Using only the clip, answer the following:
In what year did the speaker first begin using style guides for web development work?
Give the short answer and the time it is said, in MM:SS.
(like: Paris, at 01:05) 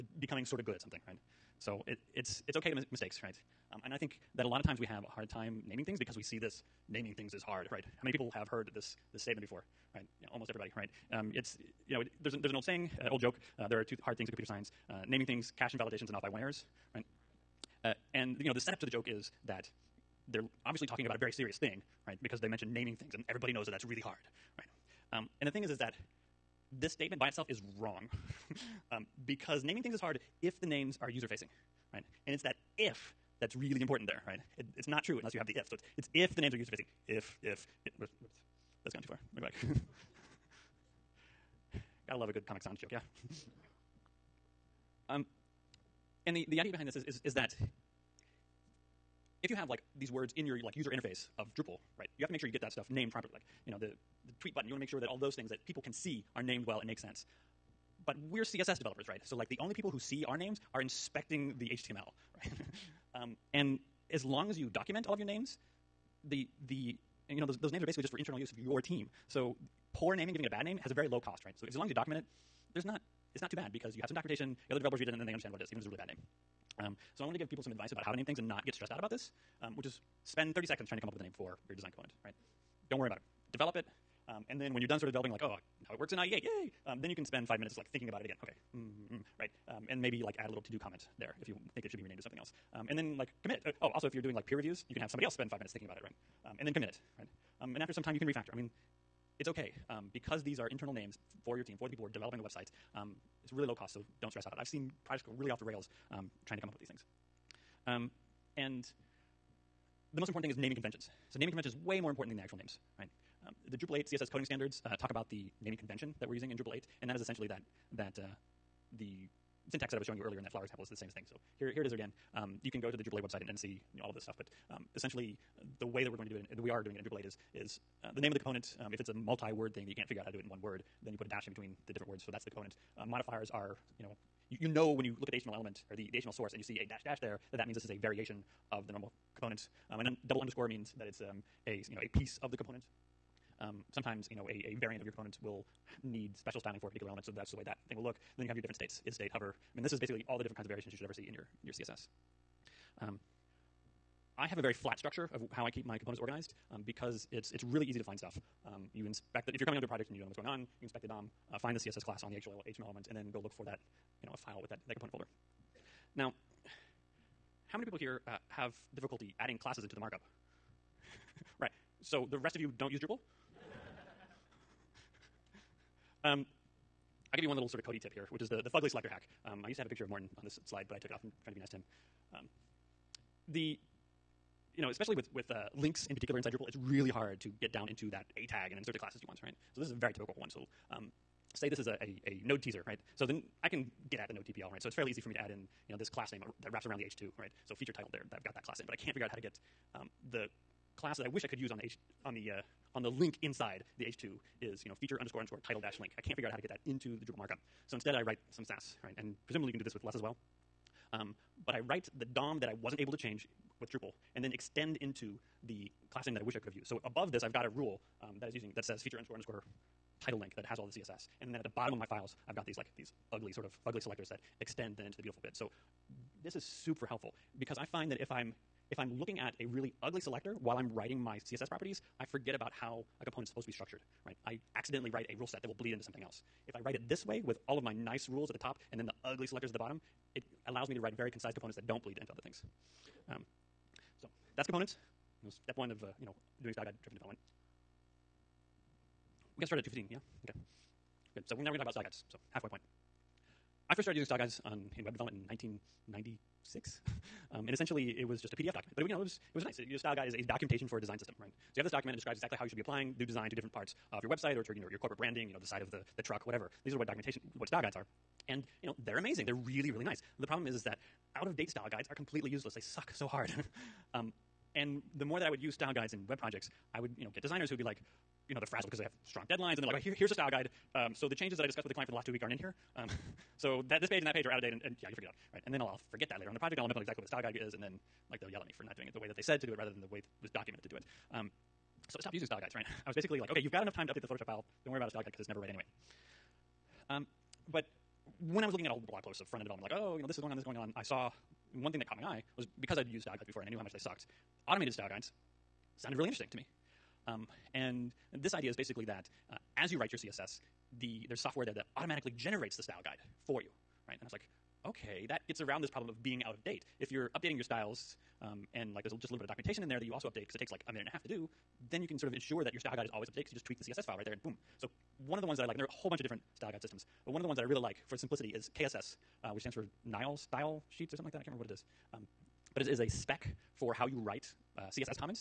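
1996, at 04:15.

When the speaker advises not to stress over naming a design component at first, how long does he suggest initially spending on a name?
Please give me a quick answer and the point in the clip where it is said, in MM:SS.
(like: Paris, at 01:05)
30 seconds, at 01:20.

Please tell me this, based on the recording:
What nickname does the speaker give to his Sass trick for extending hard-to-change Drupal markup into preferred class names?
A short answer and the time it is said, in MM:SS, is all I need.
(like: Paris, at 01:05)
Fugly selector hack, at 02:58.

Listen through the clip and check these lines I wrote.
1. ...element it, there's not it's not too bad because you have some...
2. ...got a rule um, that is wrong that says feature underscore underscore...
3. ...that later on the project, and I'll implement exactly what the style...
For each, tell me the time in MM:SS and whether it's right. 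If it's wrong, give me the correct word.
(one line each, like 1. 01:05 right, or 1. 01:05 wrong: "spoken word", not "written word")
1. 01:11 wrong: "document", not "element"
2. 03:37 wrong: "using", not "wrong"
3. 04:46 right.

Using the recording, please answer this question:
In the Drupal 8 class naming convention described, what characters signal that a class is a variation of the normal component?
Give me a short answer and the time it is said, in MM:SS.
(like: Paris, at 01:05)
dash dash, at 02:16.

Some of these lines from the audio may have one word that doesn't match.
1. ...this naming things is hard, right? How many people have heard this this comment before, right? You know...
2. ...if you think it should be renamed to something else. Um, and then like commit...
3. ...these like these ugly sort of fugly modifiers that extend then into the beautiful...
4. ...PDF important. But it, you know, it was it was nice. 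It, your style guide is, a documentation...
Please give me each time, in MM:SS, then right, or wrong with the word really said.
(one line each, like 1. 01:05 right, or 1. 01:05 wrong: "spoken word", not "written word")
1. 00:06 wrong: "statement", not "comment"
2. 01:31 right
3. 03:42 wrong: "selectors", not "modifiers"
4. 04:18 wrong: "document", not "important".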